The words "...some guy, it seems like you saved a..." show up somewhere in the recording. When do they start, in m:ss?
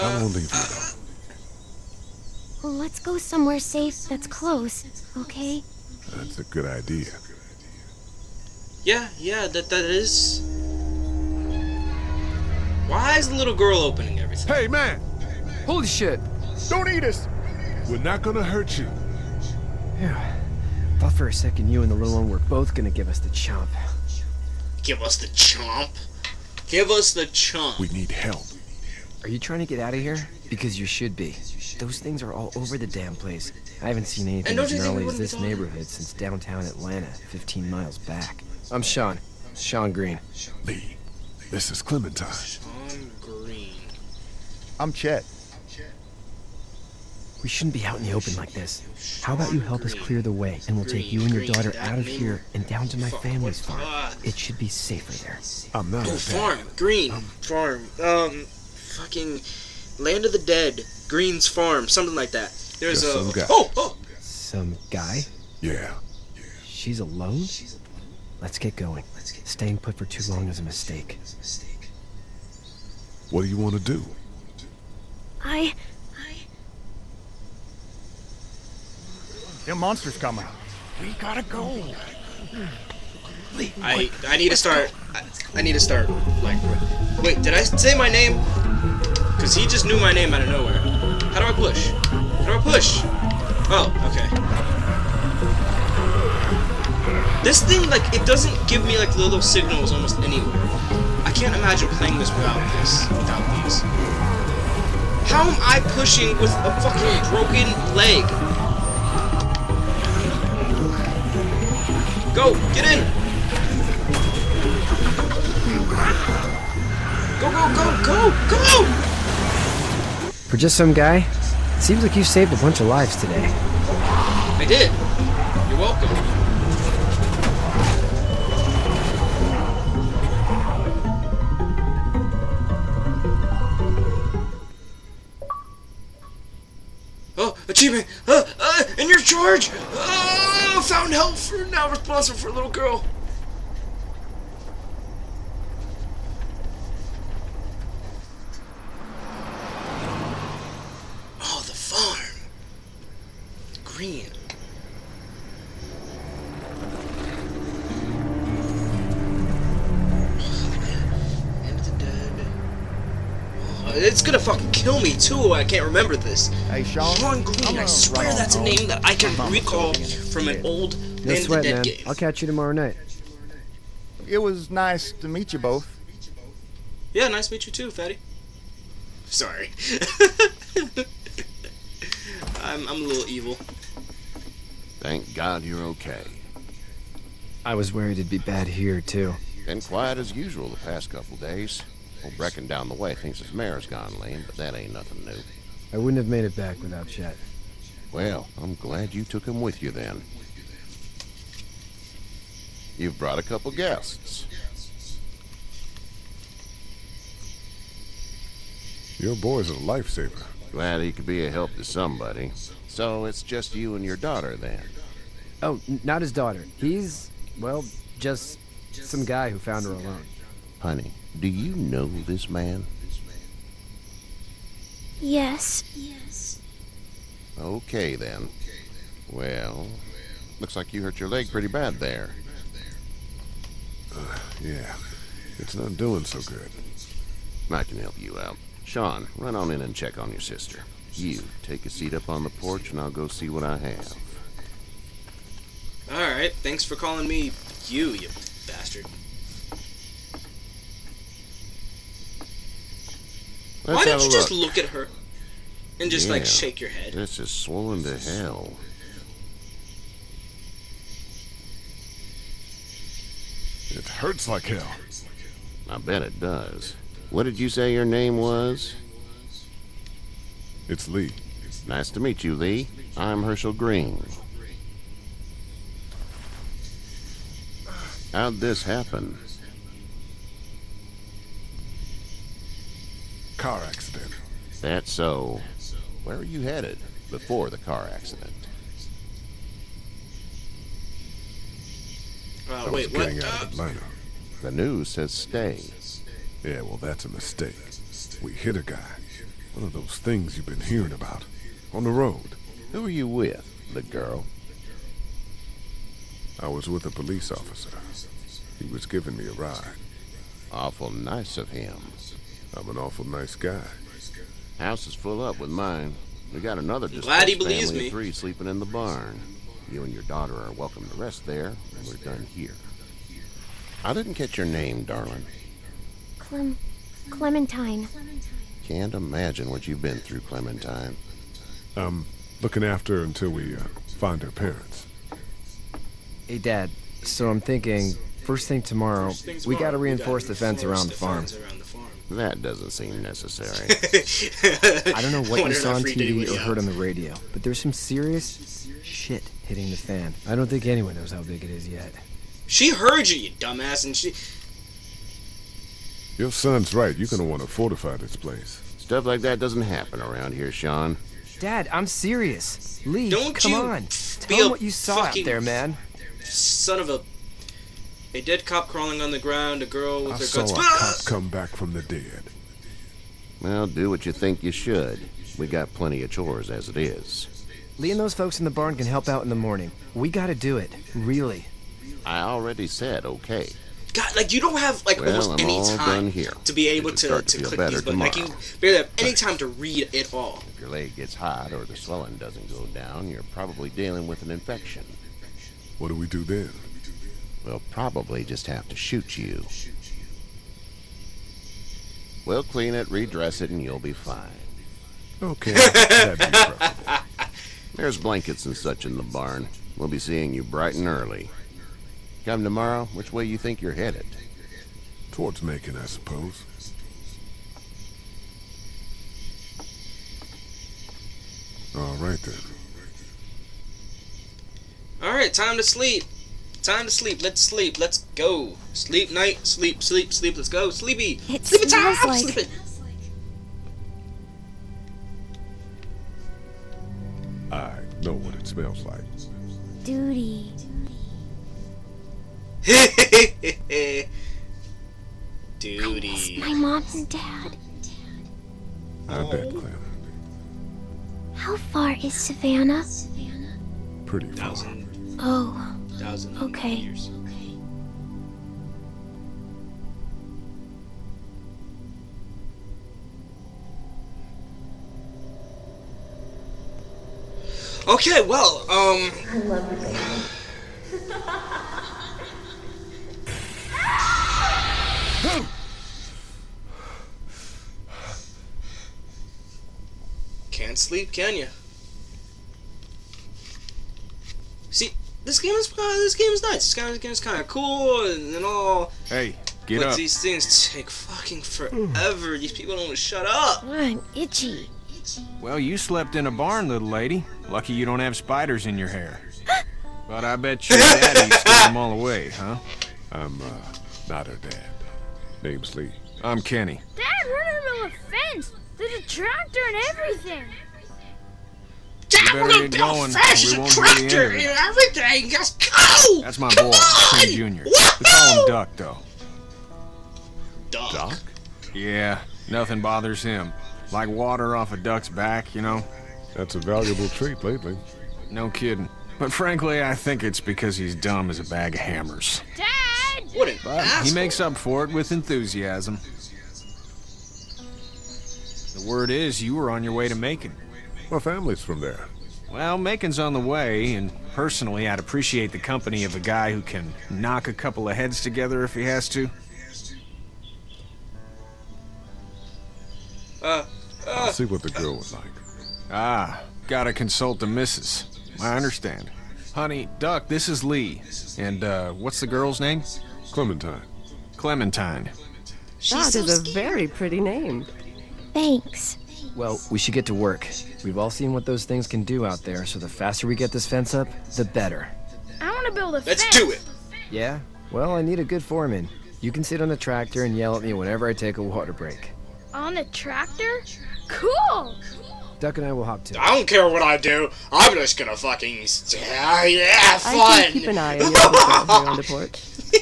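2:00.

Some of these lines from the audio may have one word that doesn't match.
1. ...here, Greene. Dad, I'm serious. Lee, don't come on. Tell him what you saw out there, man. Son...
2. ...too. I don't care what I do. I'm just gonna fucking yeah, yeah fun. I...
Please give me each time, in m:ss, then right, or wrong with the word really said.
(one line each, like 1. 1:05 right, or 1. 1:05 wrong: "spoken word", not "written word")
1. 6:00 wrong: "Shawn", not "Greene"
2. 9:46 right.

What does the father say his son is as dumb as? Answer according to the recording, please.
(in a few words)
a bag of hammers.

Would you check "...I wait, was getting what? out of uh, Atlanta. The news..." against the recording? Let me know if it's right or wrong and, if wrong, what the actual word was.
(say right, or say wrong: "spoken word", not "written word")
right.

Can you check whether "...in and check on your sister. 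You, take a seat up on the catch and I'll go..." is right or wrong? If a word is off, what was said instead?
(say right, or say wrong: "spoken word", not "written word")
wrong: "porch", not "catch".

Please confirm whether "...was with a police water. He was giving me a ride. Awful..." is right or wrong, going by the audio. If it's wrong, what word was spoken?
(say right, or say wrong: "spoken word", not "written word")
wrong: "officer", not "water".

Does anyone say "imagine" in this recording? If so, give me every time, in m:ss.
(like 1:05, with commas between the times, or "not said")
1:41, 5:29.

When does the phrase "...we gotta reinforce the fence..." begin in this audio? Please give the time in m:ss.
5:39.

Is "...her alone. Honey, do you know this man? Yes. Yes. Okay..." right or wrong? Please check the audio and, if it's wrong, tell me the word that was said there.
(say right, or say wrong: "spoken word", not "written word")
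right.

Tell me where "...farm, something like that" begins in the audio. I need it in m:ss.
1:01.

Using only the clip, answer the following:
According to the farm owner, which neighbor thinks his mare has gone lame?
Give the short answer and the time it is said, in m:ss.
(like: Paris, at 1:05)
Old Brecken, at 3:12.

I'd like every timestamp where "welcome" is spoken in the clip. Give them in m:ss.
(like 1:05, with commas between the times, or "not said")
2:05, 5:20.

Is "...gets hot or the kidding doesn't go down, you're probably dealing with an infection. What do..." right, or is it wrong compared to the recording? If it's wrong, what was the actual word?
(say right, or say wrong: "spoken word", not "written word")
wrong: "swelling", not "kidding".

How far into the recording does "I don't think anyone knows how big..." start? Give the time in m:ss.
5:50.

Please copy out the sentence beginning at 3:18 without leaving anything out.
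Well, I'm glad you took him with you then.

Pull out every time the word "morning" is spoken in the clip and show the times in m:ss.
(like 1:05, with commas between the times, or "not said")
6:19.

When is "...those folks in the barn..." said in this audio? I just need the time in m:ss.
6:18.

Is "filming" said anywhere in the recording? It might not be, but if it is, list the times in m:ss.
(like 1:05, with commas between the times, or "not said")
not said.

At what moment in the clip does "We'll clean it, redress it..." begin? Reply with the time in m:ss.
6:42.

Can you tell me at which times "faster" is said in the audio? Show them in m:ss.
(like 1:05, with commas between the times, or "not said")
9:33.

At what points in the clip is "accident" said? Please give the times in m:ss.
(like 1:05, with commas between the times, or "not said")
4:43, 4:48.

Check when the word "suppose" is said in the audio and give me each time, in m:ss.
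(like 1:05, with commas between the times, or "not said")
6:56.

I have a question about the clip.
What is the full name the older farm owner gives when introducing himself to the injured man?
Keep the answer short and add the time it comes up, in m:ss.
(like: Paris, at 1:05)
Hershel Greene, at 4:33.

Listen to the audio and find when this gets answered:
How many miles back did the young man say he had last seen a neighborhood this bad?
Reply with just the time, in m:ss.
0:37.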